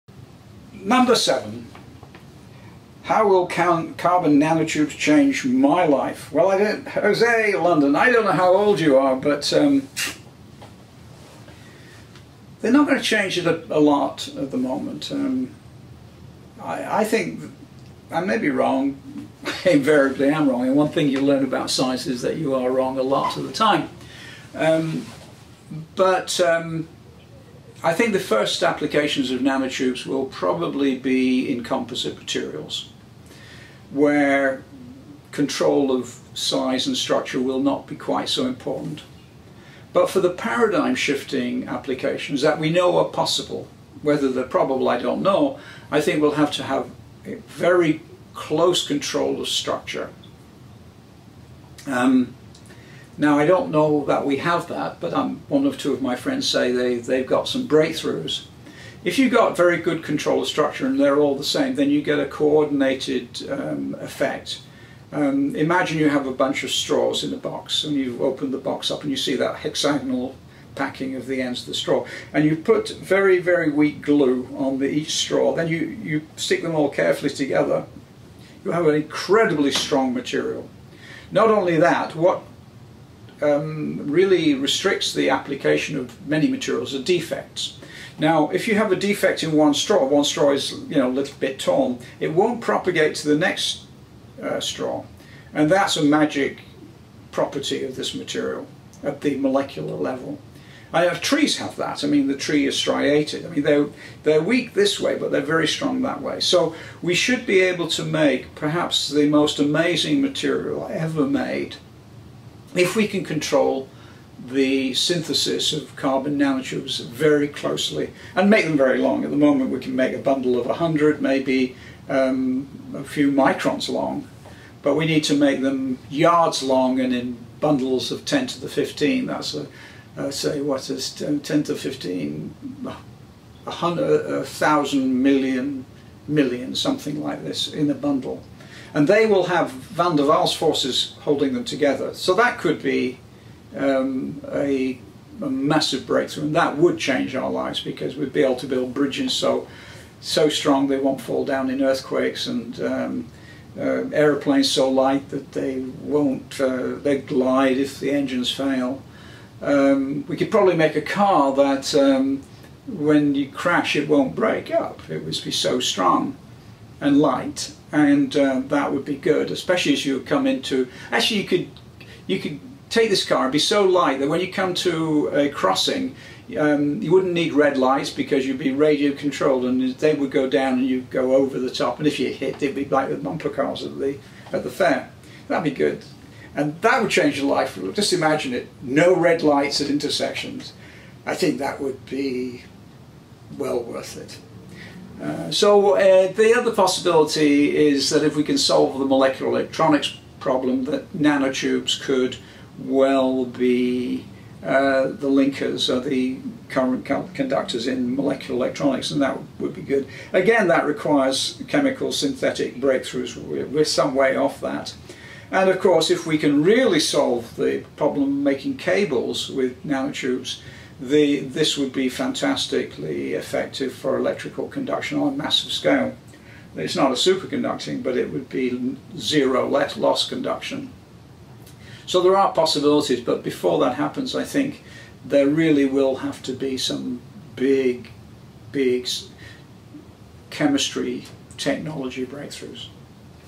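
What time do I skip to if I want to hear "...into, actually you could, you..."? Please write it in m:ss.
2:50.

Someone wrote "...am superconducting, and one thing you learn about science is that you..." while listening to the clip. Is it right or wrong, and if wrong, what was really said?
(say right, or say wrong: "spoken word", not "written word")
wrong: "wrong", not "superconducting".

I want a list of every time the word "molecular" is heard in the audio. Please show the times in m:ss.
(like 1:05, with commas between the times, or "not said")
1:39, 3:19, 3:28.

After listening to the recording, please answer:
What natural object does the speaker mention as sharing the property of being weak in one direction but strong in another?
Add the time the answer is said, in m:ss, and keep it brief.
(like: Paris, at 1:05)
trees, at 1:41.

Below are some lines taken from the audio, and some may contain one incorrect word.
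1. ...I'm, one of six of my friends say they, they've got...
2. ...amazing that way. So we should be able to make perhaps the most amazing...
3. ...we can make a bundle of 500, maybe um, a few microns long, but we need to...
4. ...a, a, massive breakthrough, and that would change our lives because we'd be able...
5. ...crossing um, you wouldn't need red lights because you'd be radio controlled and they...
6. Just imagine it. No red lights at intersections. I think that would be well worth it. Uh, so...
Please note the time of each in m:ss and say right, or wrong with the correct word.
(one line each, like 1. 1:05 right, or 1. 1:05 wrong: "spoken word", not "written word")
1. 0:55 wrong: "two", not "six"
2. 1:45 wrong: "strong", not "amazing"
3. 1:59 wrong: "100", not "500"
4. 2:24 right
5. 2:55 right
6. 3:07 right.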